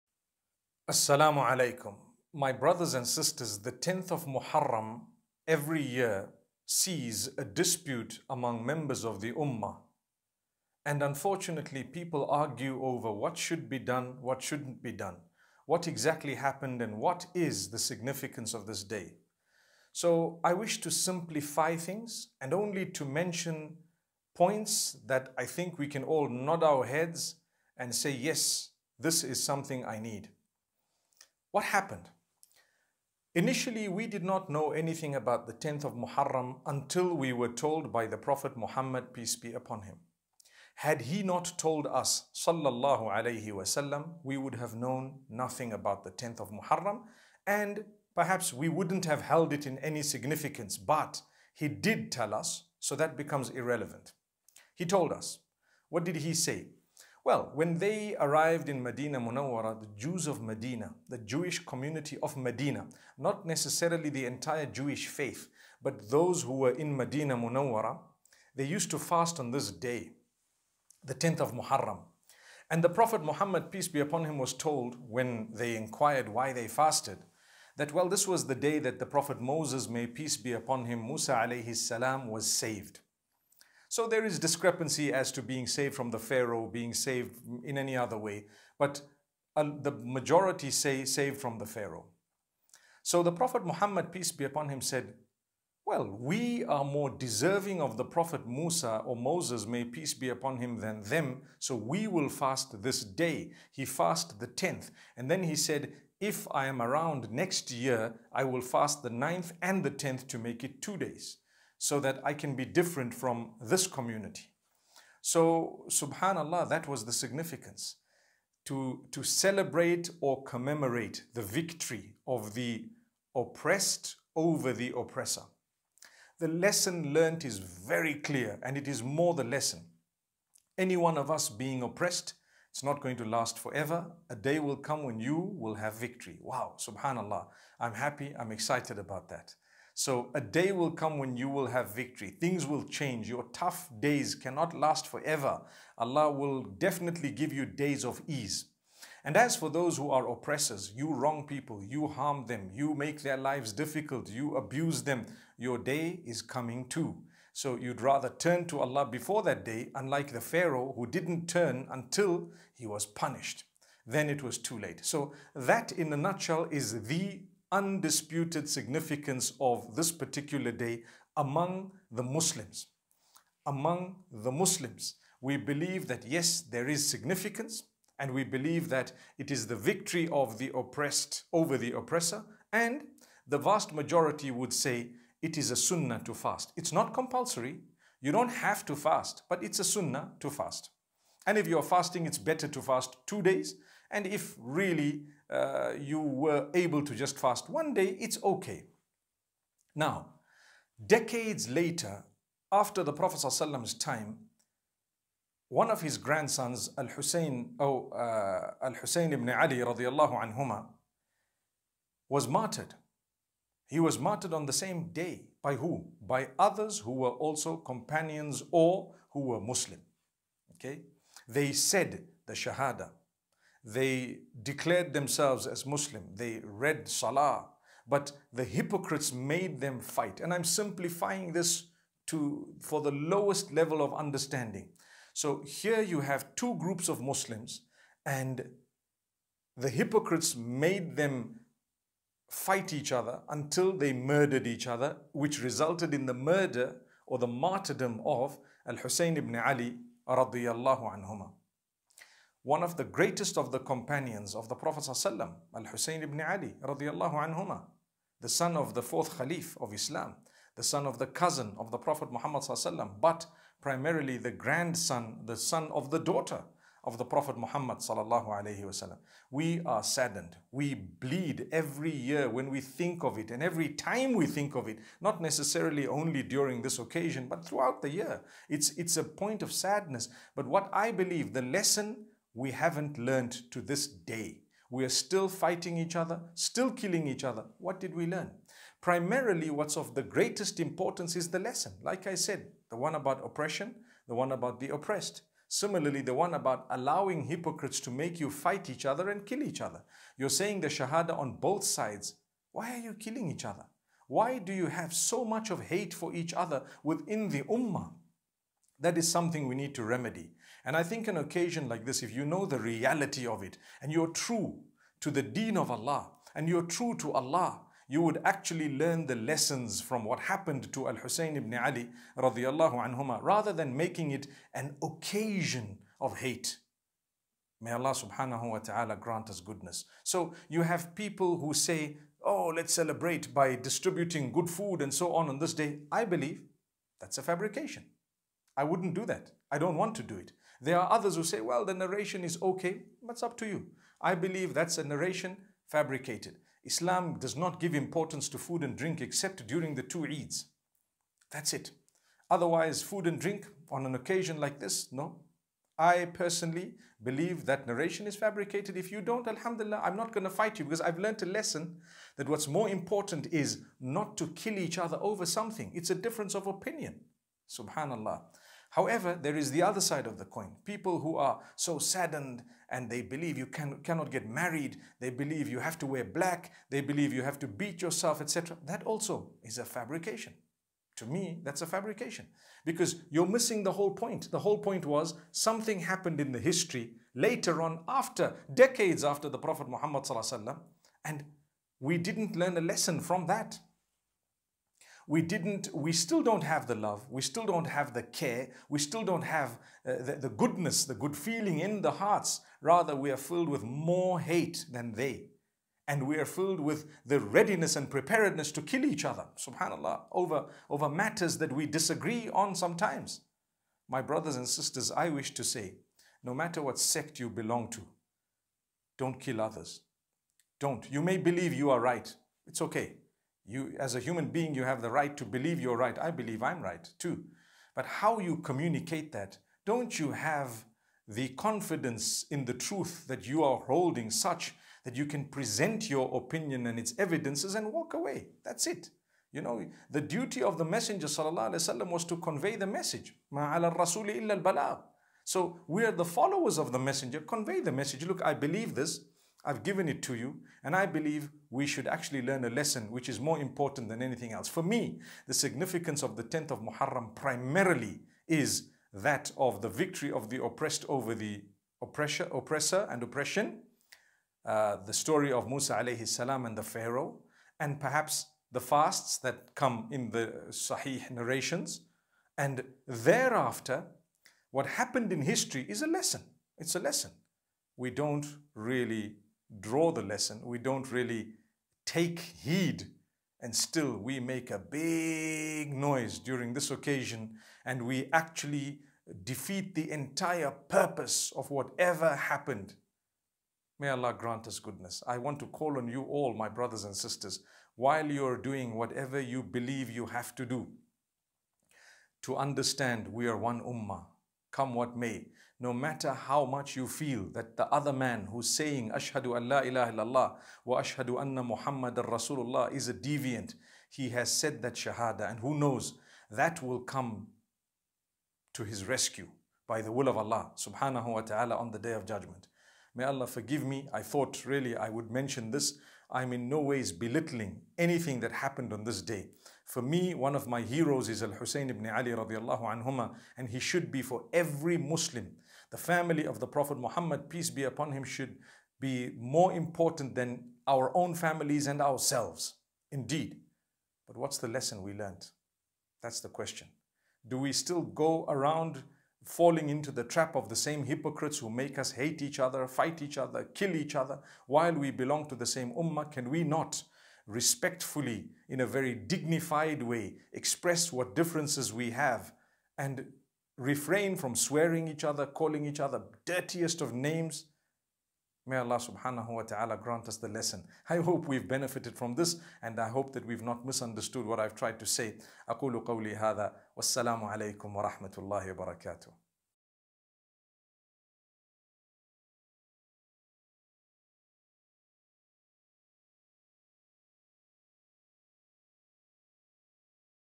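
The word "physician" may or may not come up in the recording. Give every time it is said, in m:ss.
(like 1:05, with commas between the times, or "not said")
not said.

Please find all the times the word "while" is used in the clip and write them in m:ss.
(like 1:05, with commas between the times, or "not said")
8:17, 9:14.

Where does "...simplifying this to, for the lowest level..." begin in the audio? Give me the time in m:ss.
3:50.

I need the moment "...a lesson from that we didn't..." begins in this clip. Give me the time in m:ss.
6:32.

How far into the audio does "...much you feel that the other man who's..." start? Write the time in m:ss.
8:26.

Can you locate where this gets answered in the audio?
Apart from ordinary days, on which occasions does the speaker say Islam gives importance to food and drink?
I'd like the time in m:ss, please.
5:49.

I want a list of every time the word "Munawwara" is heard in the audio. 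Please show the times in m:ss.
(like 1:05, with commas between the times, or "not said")
0:59, 1:07.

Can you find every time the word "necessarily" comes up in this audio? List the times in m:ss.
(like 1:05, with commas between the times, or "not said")
1:03, 4:35.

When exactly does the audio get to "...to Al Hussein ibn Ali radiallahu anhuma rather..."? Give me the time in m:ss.
5:20.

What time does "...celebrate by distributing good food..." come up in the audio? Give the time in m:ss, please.
5:32.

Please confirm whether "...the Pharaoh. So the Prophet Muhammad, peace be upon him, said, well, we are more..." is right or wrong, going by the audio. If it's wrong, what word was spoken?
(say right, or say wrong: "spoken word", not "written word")
right.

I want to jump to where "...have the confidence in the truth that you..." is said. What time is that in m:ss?
7:10.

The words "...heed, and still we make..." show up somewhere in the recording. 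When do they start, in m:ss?
8:02.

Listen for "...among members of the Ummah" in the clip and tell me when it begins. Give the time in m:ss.
0:08.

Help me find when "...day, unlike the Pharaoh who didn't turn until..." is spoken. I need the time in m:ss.
2:39.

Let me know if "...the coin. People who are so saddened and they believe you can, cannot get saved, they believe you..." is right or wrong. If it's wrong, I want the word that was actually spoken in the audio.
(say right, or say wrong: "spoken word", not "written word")
wrong: "married", not "saved".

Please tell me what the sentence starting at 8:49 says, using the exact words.
For me, one of my heroes is Al Hussein ibn Ali radiallahu anhuma, and he should be for every Muslim.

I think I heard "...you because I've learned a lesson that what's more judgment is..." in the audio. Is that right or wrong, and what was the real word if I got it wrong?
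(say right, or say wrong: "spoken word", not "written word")
wrong: "important", not "judgment".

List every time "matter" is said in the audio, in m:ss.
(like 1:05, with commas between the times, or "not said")
6:51, 6:56, 8:25.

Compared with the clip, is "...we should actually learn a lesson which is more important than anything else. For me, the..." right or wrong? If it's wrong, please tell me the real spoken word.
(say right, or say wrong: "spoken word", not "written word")
right.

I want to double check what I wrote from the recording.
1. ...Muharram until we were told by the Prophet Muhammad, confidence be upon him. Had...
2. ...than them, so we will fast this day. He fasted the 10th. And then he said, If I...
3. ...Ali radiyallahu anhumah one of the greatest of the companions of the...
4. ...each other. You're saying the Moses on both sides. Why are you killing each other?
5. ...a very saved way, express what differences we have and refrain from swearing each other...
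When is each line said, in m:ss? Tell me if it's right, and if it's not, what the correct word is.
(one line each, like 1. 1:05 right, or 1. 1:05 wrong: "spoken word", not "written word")
1. 0:35 wrong: "peace", not "confidence"
2. 1:40 right
3. 4:09 right
4. 4:59 wrong: "Shahada", not "Moses"
5. 9:18 wrong: "dignified", not "saved".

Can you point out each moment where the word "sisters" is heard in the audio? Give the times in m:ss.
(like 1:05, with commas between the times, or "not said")
0:03, 6:54, 8:17.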